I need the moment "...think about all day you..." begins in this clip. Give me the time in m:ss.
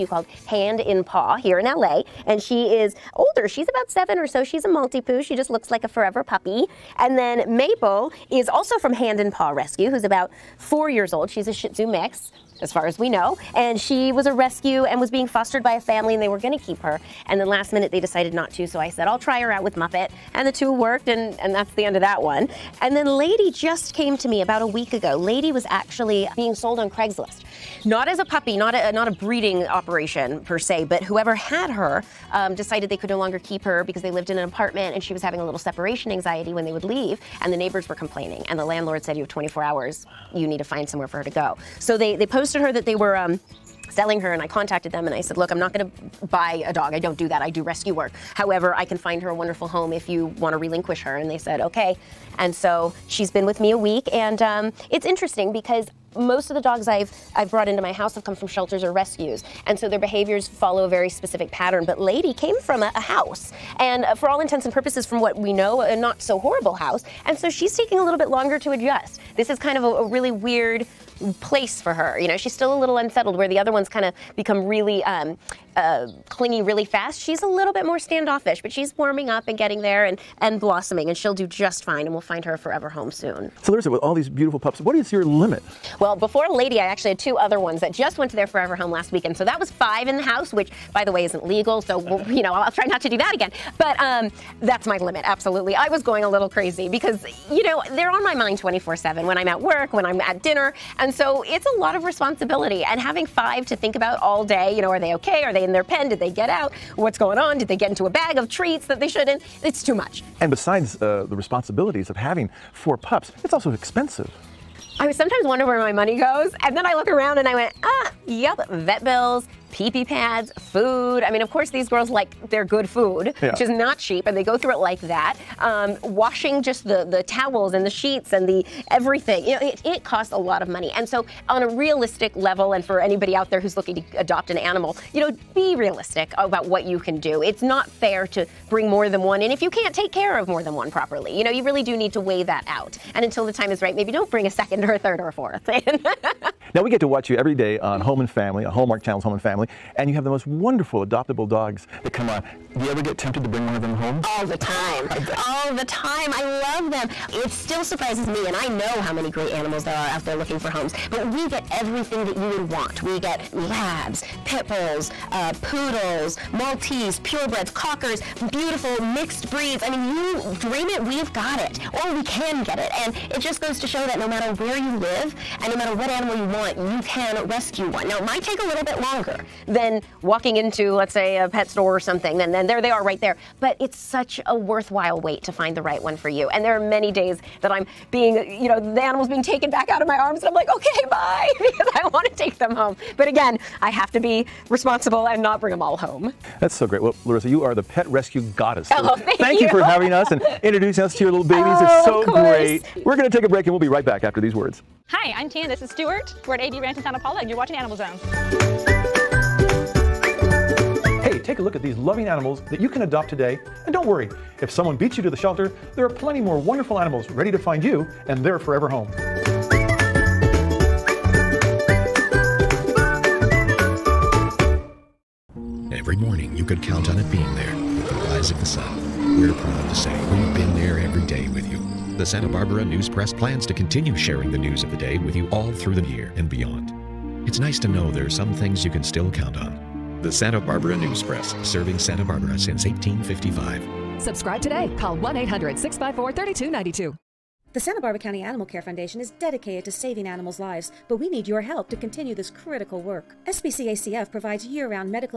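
1:43.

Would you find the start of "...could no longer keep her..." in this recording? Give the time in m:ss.
0:32.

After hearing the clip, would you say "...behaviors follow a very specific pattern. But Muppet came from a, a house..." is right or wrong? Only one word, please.
wrong.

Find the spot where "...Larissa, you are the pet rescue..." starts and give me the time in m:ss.
3:17.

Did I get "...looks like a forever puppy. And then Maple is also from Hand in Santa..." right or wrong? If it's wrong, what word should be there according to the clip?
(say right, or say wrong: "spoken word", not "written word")
wrong: "Paw", not "Santa".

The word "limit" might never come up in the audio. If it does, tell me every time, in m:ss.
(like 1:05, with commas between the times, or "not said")
1:25, 1:34.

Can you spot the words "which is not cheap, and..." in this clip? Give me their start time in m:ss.
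2:03.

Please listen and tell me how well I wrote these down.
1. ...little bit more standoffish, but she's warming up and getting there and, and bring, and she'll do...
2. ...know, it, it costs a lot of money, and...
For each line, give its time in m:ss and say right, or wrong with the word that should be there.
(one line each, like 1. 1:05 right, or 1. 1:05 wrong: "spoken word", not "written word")
1. 1:17 wrong: "blossoming", not "bring"
2. 2:09 right.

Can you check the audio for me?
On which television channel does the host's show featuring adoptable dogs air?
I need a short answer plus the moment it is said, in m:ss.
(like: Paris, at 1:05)
Hallmark Channel, at 2:28.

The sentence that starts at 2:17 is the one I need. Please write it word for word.
It's not fair to bring more than one and if you can't take care of more than one properly.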